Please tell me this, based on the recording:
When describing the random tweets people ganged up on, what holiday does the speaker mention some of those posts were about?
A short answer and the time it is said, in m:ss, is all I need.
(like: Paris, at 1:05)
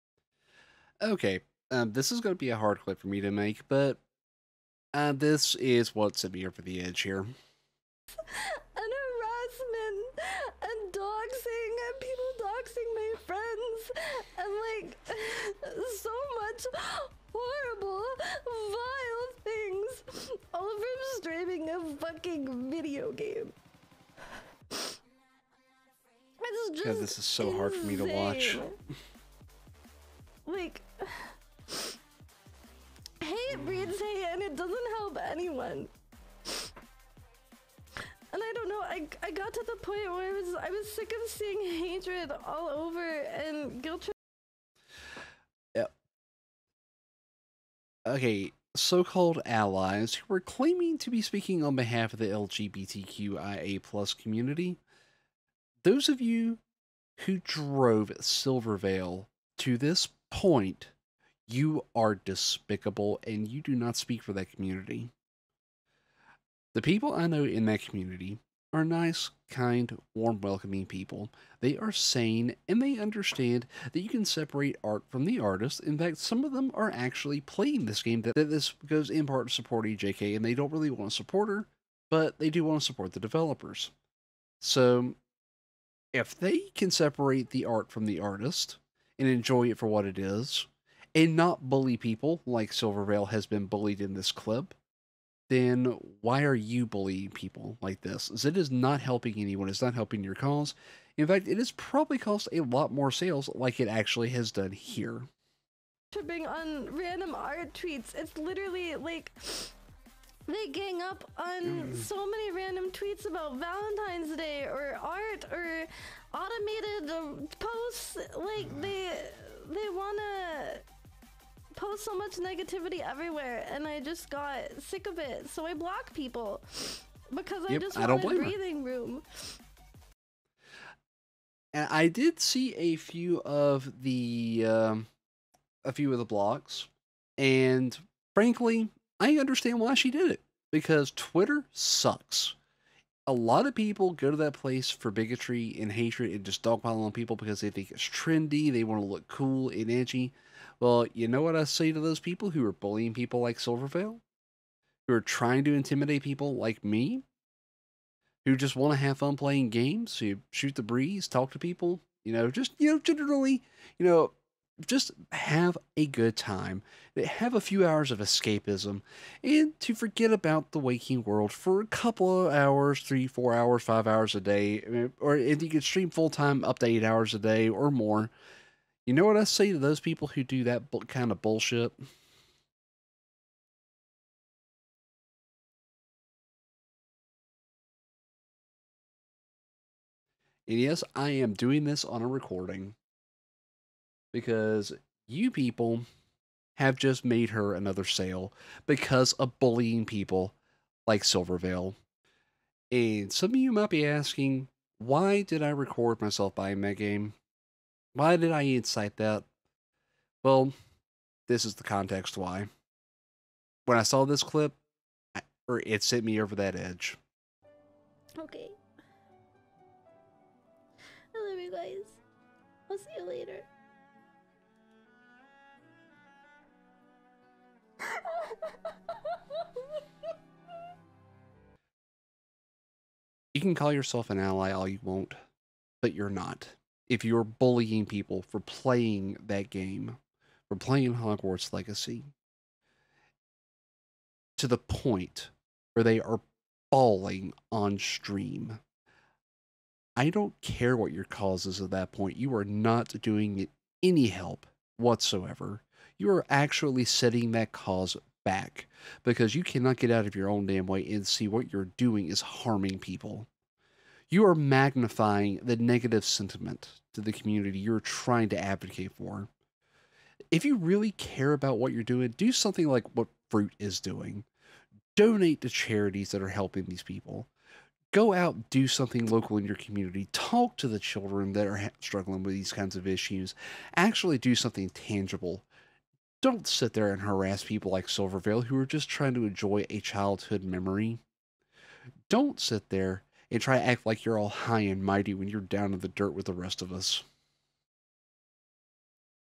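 Valentine's Day, at 1:53.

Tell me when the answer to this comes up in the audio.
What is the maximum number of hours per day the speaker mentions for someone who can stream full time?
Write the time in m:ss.
2:56.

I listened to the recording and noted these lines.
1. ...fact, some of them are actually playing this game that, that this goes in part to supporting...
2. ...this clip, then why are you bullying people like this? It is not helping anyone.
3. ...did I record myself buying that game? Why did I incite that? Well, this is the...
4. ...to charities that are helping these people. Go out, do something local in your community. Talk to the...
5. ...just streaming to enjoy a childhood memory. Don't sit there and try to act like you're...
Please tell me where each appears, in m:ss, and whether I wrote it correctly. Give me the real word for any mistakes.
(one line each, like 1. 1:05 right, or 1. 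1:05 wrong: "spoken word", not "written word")
1. 1:15 right
2. 1:34 right
3. 3:25 right
4. 4:35 right
5. 4:48 wrong: "trying", not "streaming".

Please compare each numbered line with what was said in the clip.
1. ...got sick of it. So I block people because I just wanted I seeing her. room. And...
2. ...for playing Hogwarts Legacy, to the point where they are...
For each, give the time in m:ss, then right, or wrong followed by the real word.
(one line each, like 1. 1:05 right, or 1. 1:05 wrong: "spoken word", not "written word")
1. 2:04 wrong: "breathing", not "seeing"
2. 4:00 right.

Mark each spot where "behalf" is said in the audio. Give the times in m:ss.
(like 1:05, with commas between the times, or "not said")
0:51.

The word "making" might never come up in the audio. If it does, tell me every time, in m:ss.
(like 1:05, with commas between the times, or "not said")
not said.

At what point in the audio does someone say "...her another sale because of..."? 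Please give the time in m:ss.
3:17.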